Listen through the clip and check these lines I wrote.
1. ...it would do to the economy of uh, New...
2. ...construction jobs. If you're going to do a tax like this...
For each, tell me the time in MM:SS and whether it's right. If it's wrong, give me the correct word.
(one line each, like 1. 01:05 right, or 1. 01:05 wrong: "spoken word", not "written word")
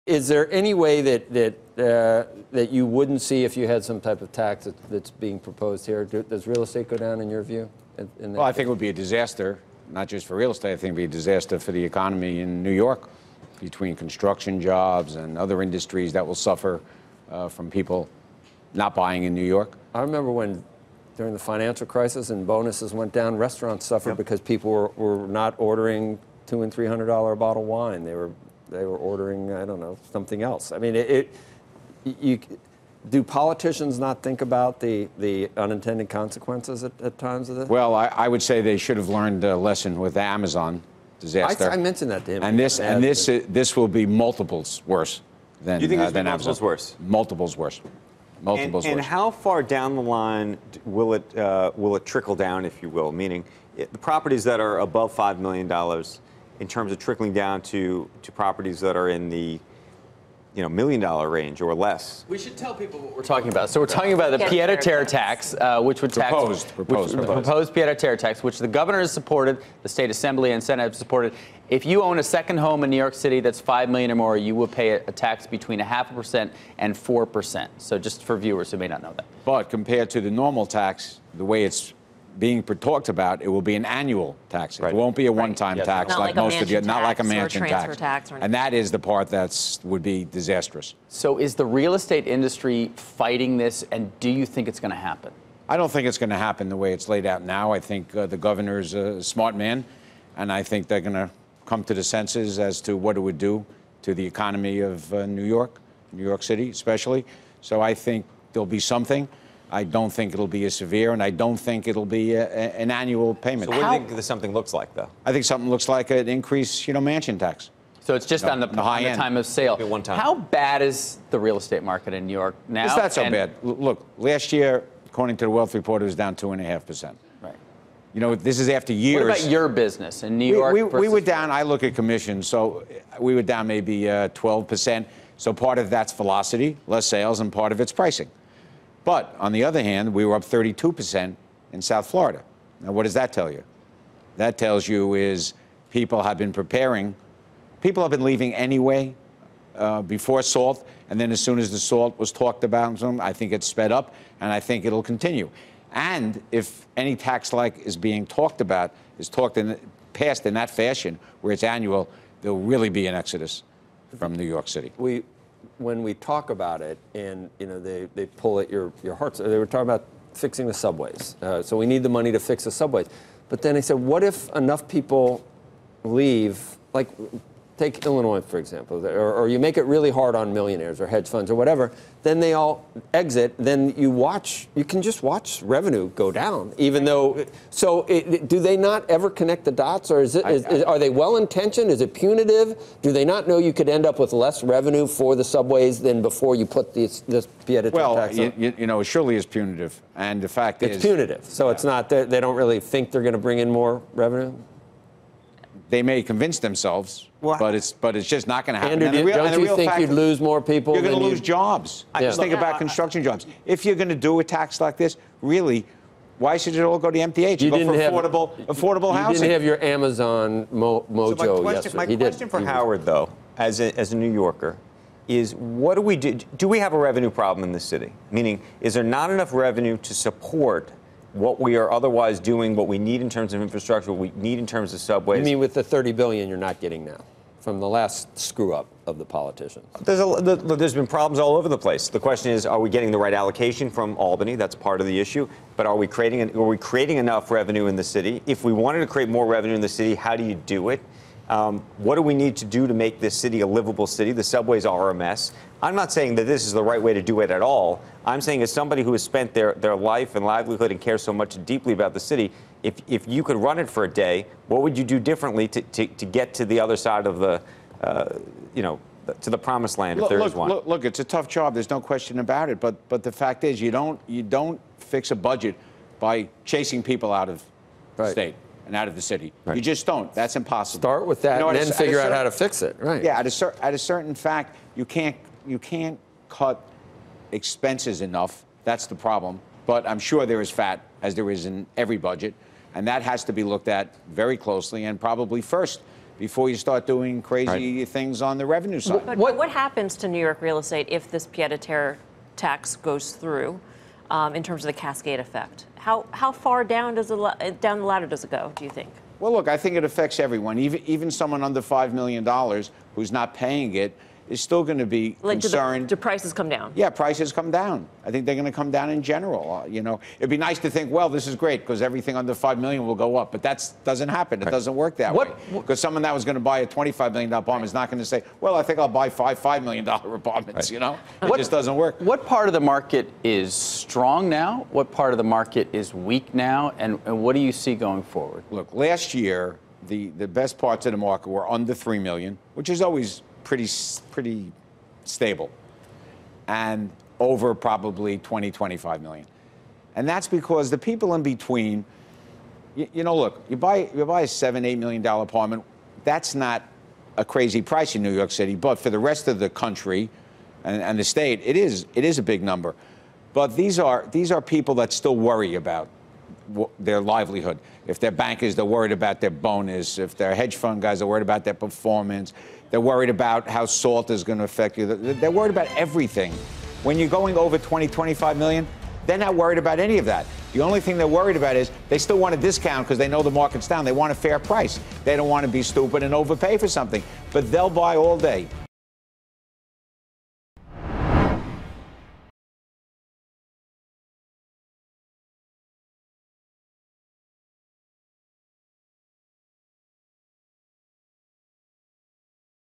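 1. 01:43 right
2. 03:32 right.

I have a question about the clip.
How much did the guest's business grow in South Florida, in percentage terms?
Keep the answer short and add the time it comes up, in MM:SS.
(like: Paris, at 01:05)
32%, at 02:20.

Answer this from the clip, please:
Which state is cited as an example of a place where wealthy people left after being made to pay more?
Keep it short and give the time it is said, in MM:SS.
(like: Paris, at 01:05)
Illinois, at 02:58.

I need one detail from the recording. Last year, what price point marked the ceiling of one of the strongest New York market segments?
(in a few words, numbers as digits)
3 million.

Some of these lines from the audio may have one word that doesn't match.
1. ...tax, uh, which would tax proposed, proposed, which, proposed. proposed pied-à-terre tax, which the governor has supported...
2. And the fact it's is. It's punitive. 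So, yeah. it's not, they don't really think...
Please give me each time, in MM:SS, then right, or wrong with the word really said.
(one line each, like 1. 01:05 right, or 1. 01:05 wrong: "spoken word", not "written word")
1. 01:05 right
2. 03:20 right.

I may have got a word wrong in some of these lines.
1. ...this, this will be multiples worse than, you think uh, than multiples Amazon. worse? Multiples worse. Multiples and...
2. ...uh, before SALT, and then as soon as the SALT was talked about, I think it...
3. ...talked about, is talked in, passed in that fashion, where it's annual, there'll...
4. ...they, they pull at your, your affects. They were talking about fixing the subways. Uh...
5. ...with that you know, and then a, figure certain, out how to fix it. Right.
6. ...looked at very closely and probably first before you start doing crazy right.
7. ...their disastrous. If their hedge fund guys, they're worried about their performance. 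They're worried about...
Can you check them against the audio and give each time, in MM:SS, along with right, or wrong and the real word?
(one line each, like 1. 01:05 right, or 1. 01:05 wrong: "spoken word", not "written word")
1. 00:43 right
2. 02:29 right
3. 02:38 right
4. 02:47 wrong: "hearts", not "affects"
5. 04:41 right
6. 04:53 right
7. 06:09 wrong: "bonus", not "disastrous".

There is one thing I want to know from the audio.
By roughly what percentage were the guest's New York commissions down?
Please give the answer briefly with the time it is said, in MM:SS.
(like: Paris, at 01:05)
12 percent, at 02:14.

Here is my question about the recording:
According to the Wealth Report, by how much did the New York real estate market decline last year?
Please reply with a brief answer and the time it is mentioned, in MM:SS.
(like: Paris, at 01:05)
2.5 percent, at 02:06.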